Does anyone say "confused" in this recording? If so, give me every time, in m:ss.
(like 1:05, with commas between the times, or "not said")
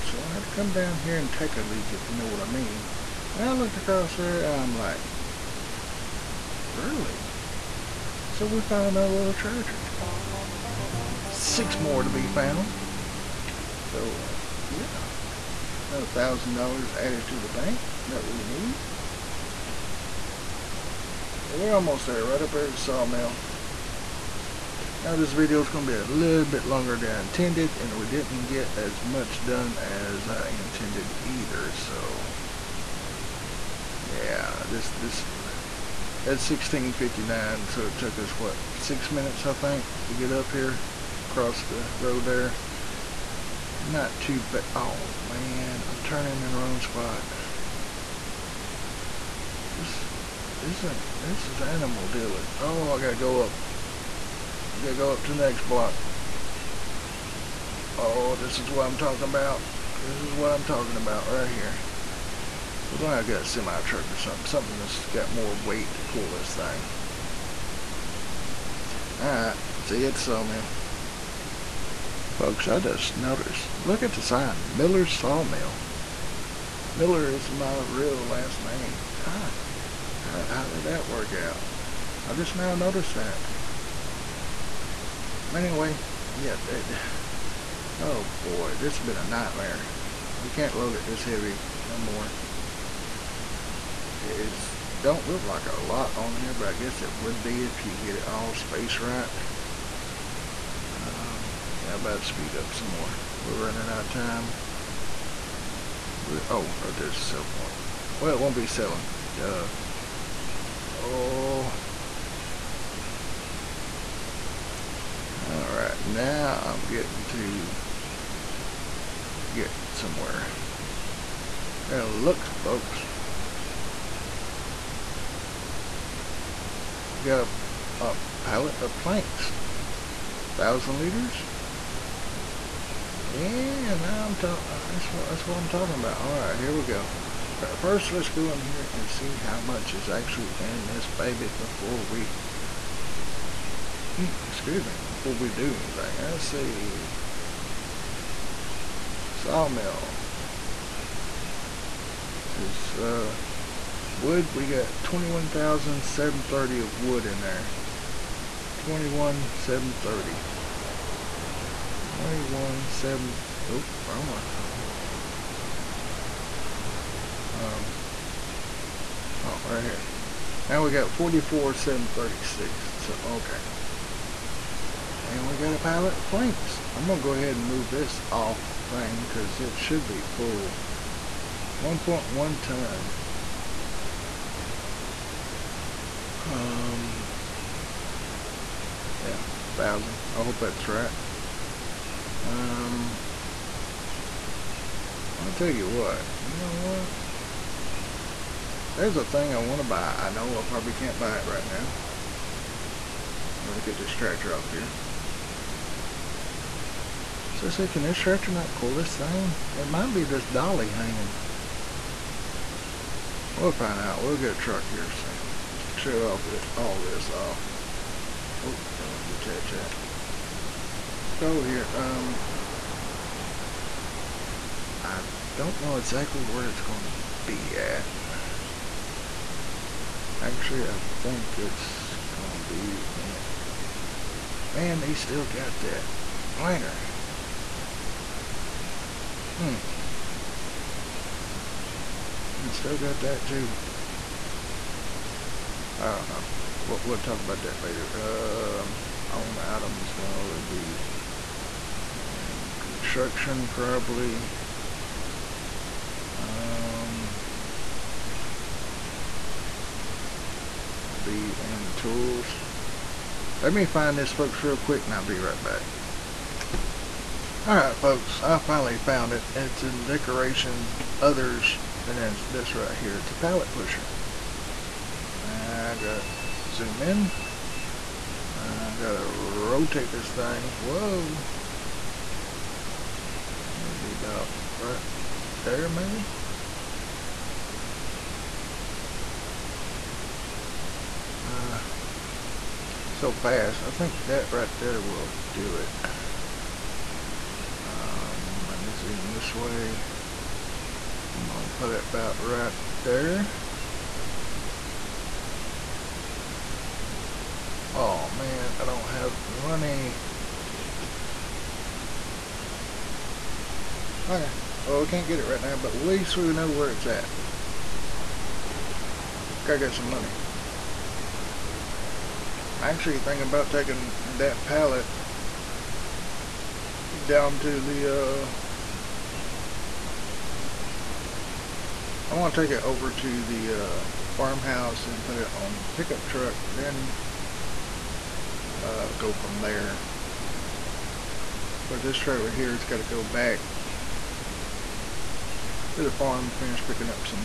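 not said.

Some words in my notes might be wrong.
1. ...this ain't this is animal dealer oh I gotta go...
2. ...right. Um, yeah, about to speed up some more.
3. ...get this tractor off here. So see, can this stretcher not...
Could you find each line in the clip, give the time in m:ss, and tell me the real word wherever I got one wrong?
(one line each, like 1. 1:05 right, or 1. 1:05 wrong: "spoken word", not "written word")
1. 0:50 right
2. 1:38 right
3. 3:23 right.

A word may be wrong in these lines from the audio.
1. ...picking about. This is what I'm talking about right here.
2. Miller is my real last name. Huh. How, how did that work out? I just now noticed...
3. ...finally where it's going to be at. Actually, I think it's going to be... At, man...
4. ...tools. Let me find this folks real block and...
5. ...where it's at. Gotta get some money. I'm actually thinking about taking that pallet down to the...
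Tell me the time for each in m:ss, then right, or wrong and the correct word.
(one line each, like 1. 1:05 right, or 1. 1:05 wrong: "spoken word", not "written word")
1. 0:58 wrong: "talking", not "picking"
2. 1:16 right
3. 3:45 wrong: "exactly", not "finally"
4. 4:21 wrong: "quick", not "block"
5. 5:16 right.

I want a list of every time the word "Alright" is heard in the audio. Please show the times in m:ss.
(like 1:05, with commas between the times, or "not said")
1:09, 1:55, 4:27.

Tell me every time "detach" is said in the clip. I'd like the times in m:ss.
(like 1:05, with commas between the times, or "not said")
3:39.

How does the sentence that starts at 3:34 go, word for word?
We'll get a truck here soon.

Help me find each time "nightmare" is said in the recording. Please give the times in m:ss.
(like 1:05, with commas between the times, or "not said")
1:29.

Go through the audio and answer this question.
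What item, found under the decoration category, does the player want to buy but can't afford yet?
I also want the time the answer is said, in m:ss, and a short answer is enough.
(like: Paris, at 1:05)
pallet pusher, at 4:33.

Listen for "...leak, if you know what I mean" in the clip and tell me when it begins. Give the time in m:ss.
0:01.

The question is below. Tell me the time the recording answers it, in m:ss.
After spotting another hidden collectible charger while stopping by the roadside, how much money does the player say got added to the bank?
0:15.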